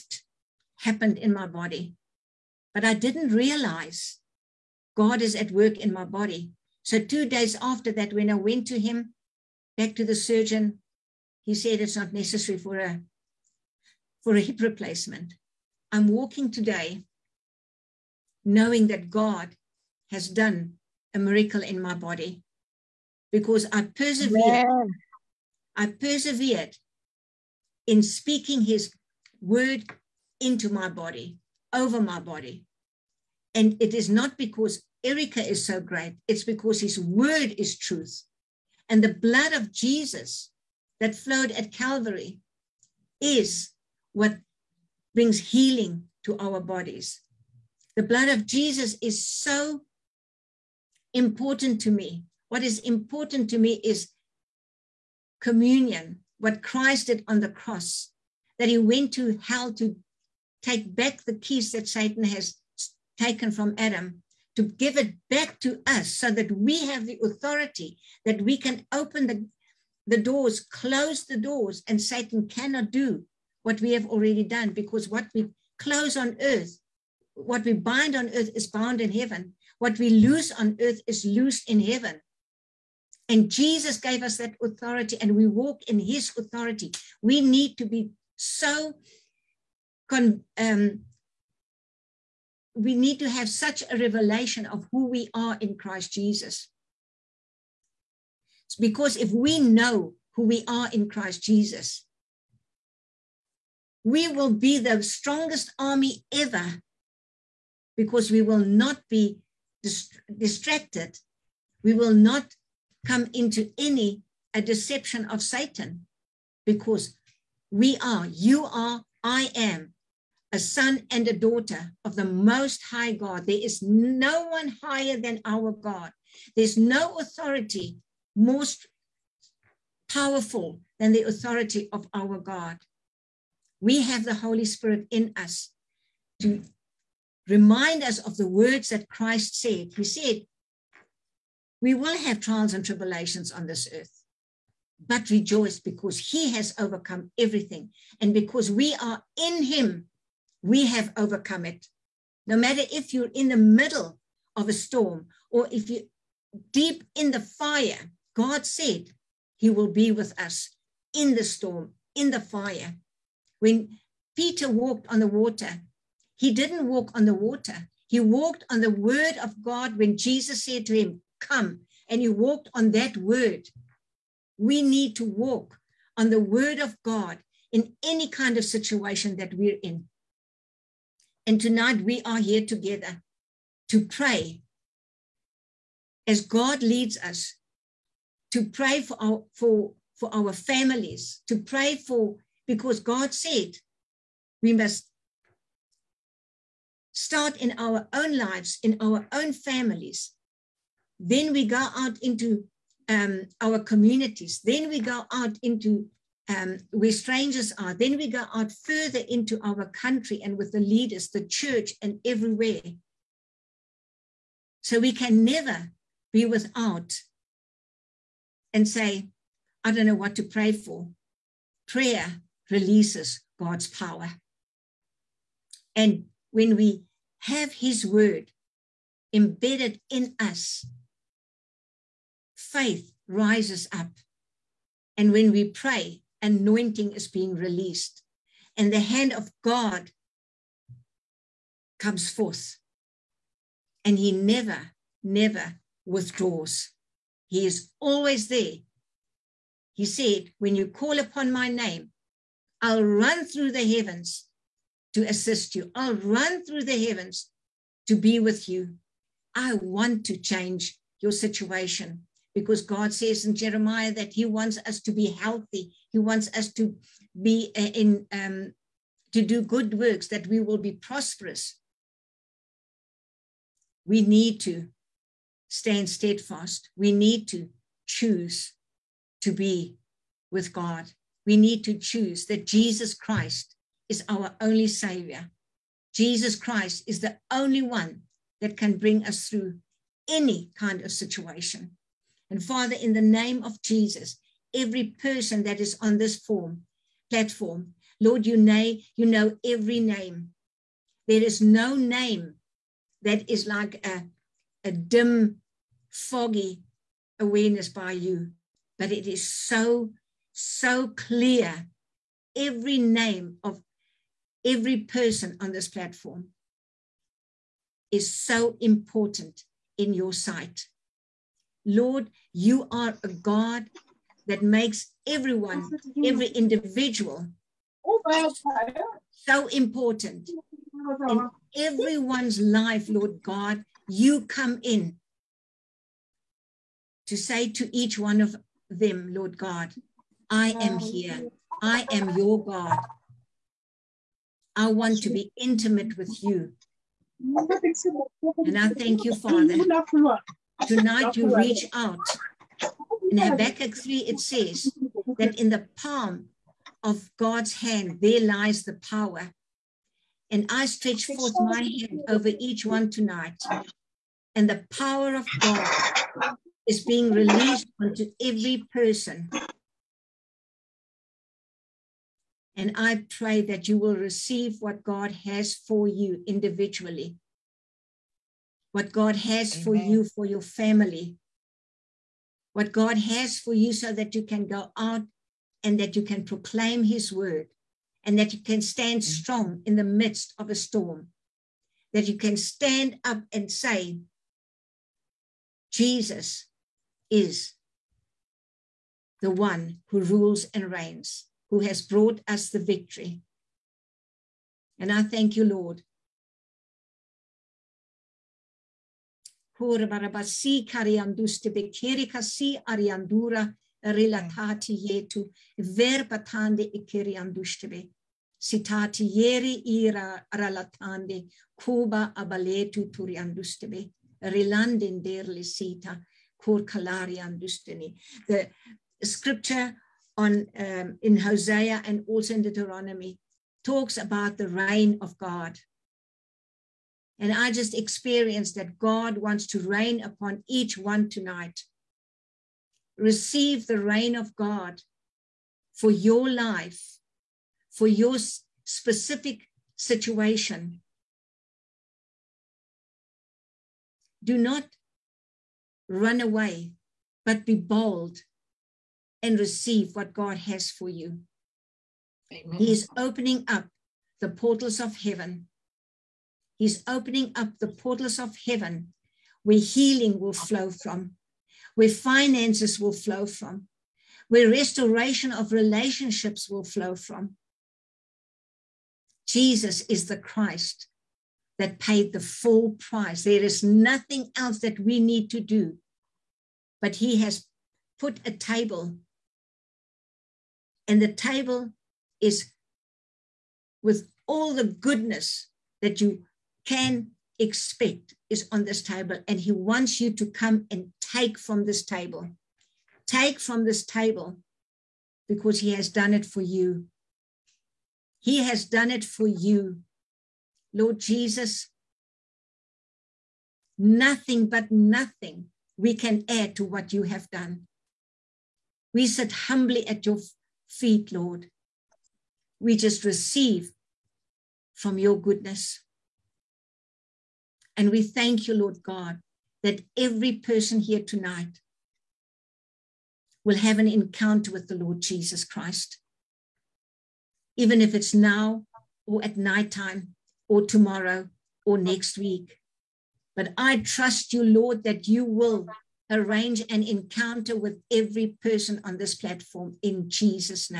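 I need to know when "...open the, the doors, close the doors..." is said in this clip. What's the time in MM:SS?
01:08.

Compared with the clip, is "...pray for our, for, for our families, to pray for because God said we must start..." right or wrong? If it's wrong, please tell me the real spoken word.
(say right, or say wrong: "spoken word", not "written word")
right.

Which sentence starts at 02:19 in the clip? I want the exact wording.
He said, We will have trials and tribulations on this earth, but rejoice because He has overcome everything.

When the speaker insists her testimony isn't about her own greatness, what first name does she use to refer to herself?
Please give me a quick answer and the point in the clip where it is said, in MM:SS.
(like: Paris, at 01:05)
Erica, at 00:35.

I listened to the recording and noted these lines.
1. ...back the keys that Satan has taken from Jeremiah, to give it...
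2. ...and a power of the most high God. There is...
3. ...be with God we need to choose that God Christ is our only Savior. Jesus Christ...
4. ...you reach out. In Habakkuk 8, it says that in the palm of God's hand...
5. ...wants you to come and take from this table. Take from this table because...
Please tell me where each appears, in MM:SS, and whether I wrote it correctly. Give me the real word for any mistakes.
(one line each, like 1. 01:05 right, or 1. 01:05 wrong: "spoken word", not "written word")
1. 01:00 wrong: "Adam", not "Jeremiah"
2. 02:01 wrong: "daughter", not "power"
3. 04:39 wrong: "Jesus", not "God"
4. 05:51 wrong: "3", not "8"
5. 08:19 right.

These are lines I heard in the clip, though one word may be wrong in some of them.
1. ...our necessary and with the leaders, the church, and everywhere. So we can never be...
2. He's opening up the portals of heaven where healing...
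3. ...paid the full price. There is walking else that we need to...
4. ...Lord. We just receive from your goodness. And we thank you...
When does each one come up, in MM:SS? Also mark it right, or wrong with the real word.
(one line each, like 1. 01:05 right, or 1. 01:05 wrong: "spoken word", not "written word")
1. 03:29 wrong: "country", not "necessary"
2. 07:46 right
3. 08:01 wrong: "nothing", not "walking"
4. 08:41 right.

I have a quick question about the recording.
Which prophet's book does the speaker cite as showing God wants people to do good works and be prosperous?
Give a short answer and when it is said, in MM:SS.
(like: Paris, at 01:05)
Jeremiah, at 04:23.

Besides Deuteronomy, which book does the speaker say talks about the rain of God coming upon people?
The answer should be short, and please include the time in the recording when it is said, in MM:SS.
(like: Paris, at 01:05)
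Hosea, at 07:11.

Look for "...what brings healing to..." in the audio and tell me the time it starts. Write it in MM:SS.
00:44.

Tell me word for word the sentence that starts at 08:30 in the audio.
Lord Jesus, nothing but nothing we can add to what you have done.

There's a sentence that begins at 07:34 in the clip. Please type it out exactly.
Do not run away, but be bold and receive what God has for you.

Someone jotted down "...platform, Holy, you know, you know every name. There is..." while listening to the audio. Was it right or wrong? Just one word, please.
wrong.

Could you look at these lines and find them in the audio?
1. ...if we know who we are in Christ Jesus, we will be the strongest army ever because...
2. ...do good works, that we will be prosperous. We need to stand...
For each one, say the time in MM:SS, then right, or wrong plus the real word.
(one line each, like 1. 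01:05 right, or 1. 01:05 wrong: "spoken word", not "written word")
1. 01:39 right
2. 04:29 right.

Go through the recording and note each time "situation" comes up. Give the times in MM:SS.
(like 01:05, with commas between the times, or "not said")
02:58, 04:21, 04:51, 07:29.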